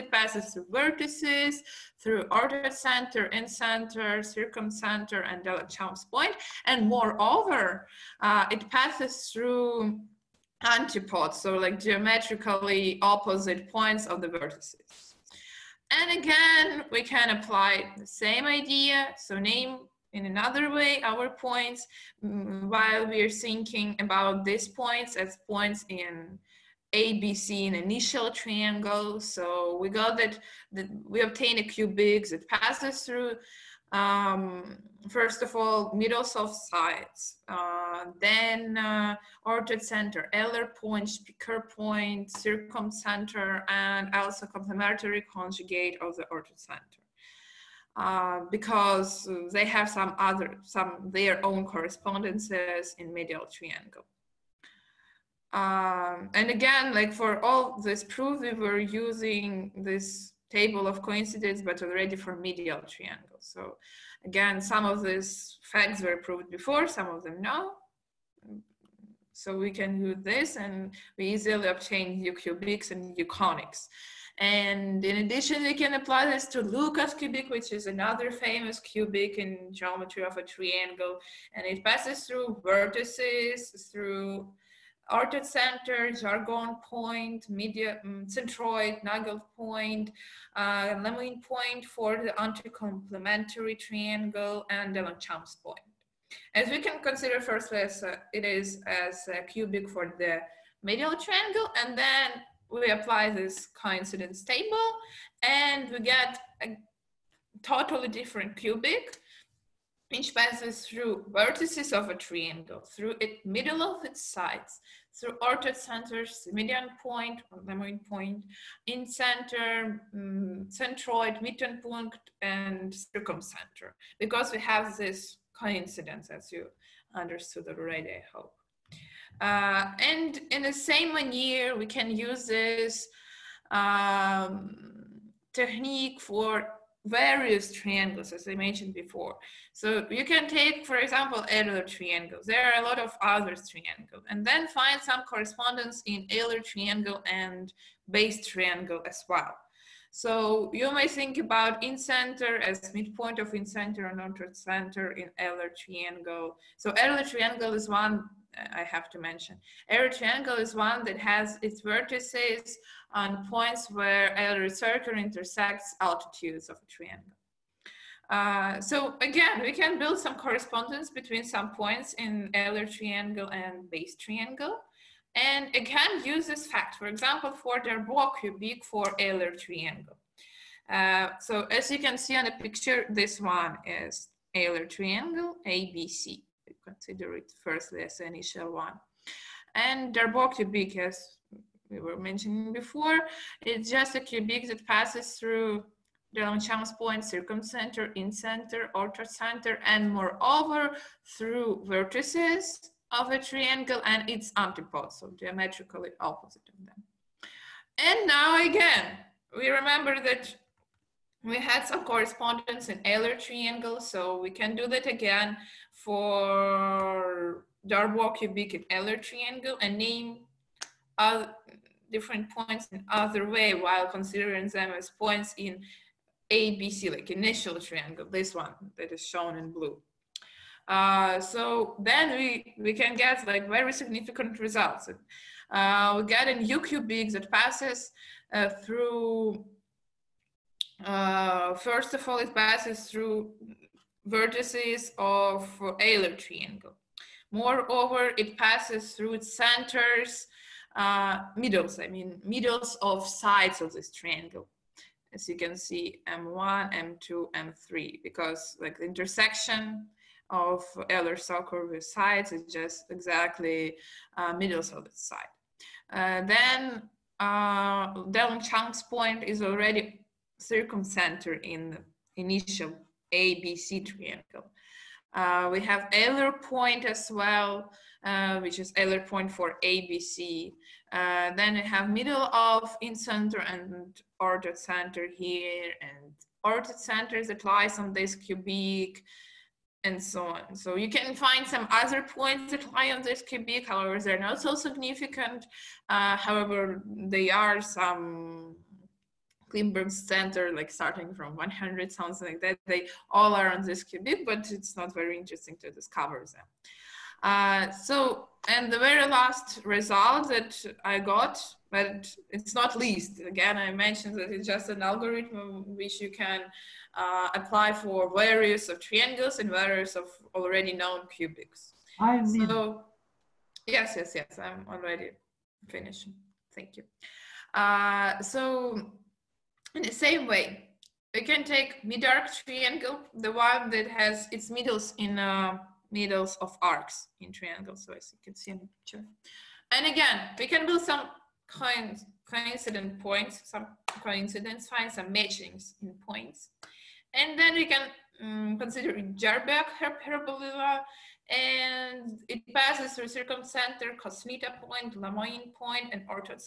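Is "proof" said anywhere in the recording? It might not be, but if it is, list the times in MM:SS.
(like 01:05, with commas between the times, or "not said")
00:58.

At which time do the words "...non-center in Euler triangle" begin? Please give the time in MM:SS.
02:34.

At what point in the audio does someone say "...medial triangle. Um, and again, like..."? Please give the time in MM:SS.
00:53.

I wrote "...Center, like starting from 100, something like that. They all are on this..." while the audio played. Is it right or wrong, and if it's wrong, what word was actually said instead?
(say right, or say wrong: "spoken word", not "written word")
right.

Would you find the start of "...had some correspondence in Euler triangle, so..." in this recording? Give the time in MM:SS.
03:31.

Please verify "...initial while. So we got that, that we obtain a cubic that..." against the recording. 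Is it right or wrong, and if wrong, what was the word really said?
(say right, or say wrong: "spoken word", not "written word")
wrong: "triangle", not "while".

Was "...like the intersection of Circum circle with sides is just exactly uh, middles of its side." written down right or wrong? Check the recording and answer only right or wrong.
wrong.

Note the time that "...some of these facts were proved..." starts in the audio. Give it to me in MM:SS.
01:04.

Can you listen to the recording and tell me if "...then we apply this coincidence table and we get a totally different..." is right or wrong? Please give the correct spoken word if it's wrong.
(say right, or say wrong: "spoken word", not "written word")
right.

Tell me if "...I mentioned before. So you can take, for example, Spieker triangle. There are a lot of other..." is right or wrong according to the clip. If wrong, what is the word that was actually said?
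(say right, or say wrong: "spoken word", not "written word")
wrong: "Euler", not "Spieker".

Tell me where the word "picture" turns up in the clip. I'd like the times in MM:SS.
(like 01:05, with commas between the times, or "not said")
03:02, 05:38.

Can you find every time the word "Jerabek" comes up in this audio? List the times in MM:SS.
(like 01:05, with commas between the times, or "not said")
05:49.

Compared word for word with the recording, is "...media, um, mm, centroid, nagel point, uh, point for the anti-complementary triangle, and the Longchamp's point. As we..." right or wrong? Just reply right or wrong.
right.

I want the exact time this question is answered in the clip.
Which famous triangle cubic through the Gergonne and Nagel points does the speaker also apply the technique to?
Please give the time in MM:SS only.
01:16.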